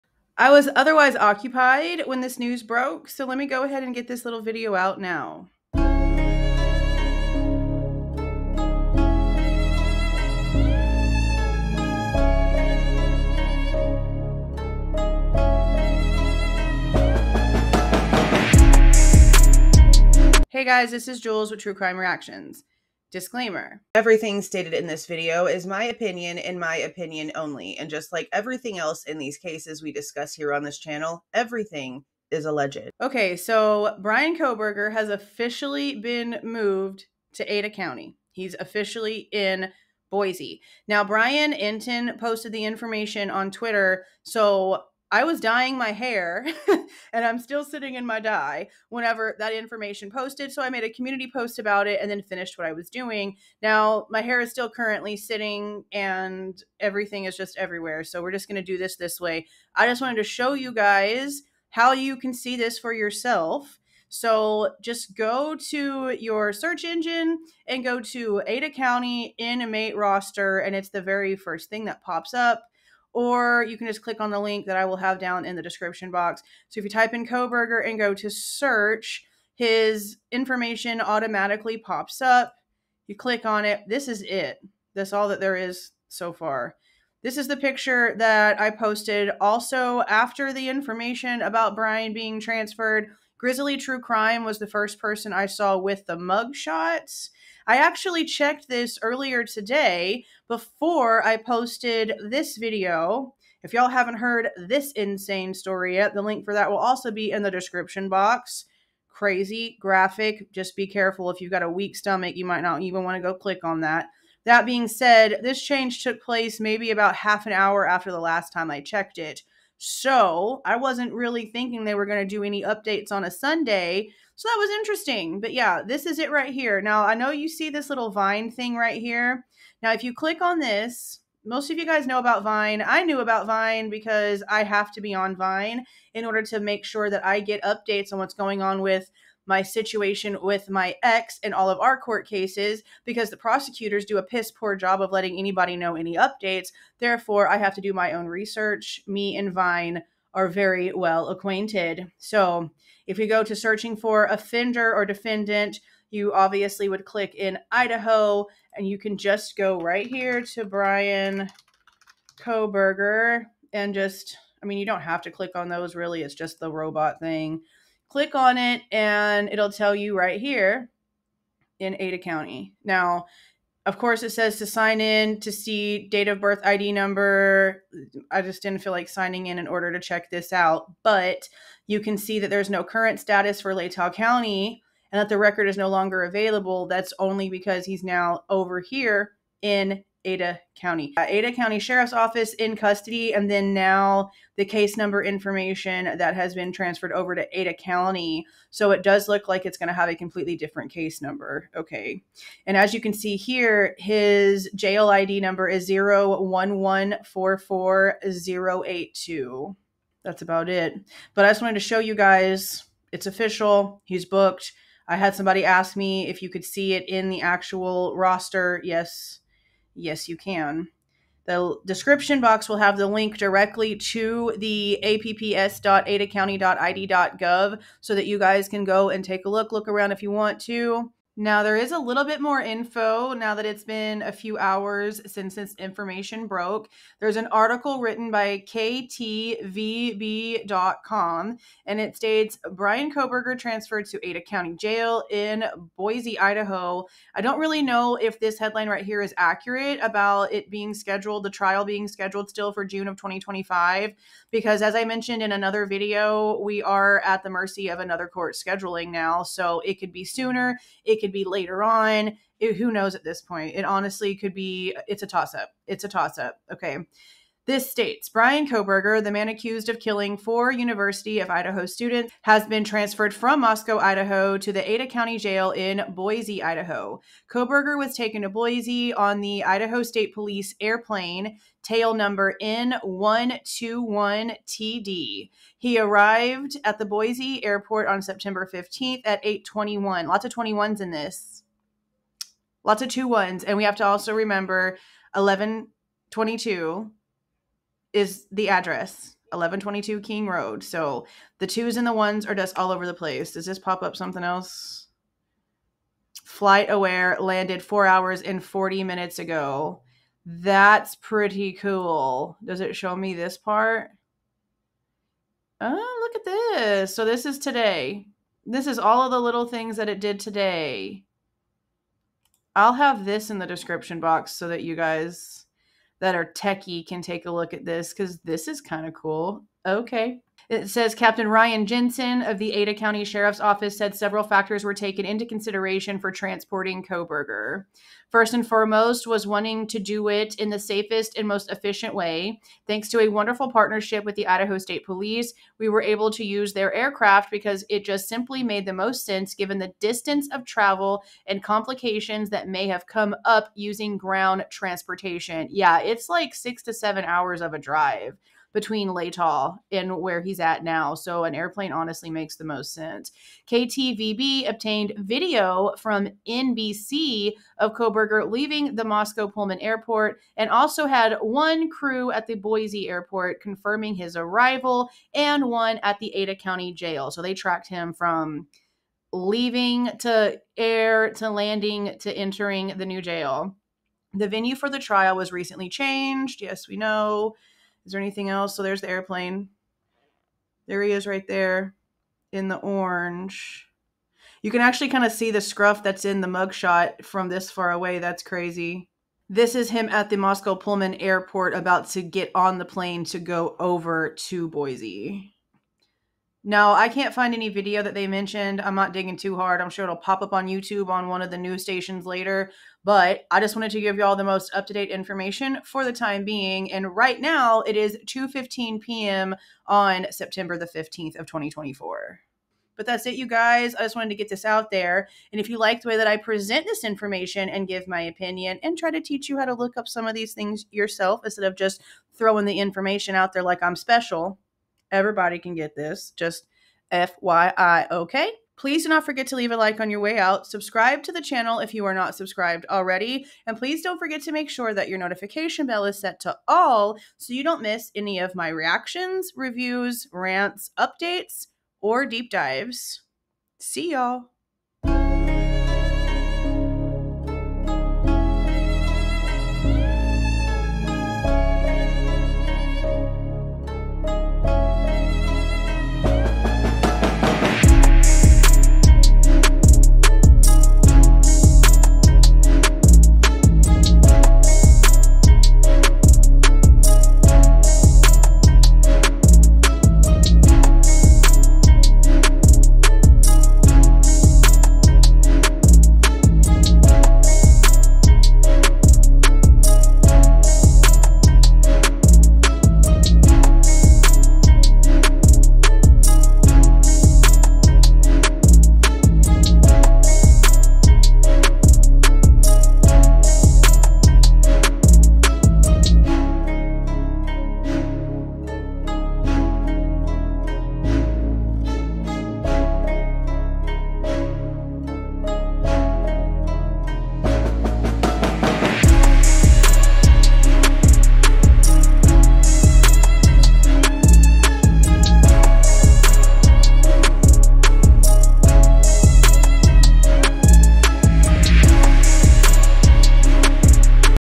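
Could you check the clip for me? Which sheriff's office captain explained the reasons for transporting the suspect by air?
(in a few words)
Ryan Jensen.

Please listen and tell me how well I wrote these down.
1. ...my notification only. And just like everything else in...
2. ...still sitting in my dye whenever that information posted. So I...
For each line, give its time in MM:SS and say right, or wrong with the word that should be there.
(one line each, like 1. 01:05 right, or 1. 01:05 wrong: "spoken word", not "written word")
1. 00:26 wrong: "opinion", not "notification"
2. 00:47 right.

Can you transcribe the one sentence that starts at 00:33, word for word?
Okay, so Bryan Kohberger has officially been moved to Ada County.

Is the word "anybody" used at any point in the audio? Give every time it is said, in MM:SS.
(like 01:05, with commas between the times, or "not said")
02:25.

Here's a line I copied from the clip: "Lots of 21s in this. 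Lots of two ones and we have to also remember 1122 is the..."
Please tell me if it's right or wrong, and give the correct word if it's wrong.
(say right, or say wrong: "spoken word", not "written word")
right.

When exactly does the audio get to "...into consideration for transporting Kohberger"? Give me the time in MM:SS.
05:35.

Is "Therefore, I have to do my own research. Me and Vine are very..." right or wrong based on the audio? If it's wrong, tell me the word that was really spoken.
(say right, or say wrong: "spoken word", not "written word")
right.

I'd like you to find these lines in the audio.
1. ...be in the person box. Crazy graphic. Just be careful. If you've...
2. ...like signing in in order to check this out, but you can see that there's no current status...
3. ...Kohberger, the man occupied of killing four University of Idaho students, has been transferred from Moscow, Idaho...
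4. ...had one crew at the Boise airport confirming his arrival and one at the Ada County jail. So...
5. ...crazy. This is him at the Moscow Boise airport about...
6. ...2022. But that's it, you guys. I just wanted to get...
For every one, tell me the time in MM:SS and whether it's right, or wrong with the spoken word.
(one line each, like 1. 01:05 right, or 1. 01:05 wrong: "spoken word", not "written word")
1. 01:47 wrong: "description", not "person"
2. 02:58 right
3. 04:28 wrong: "accused", not "occupied"
4. 06:11 right
5. 06:38 wrong: "Pullman", not "Boise"
6. 07:01 wrong: "2024", not "2022".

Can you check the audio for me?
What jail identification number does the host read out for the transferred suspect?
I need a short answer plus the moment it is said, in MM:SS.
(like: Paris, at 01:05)
01144082, at 03:25.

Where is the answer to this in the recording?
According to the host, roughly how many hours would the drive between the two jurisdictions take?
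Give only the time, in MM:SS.
05:56.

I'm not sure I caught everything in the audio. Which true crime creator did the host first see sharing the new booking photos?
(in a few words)
Grizzly True Crime.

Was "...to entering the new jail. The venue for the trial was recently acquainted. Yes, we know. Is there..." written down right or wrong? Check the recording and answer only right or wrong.
wrong.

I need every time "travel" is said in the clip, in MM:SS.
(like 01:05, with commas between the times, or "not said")
05:50.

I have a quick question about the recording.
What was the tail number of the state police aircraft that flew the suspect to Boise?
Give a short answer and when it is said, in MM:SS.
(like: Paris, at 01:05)
N121TD, at 04:42.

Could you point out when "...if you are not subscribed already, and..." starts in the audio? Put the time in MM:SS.
07:21.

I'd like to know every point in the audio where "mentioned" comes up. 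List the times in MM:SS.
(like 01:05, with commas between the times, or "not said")
04:15, 06:48.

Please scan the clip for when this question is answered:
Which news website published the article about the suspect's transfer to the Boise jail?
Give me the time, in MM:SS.
03:58.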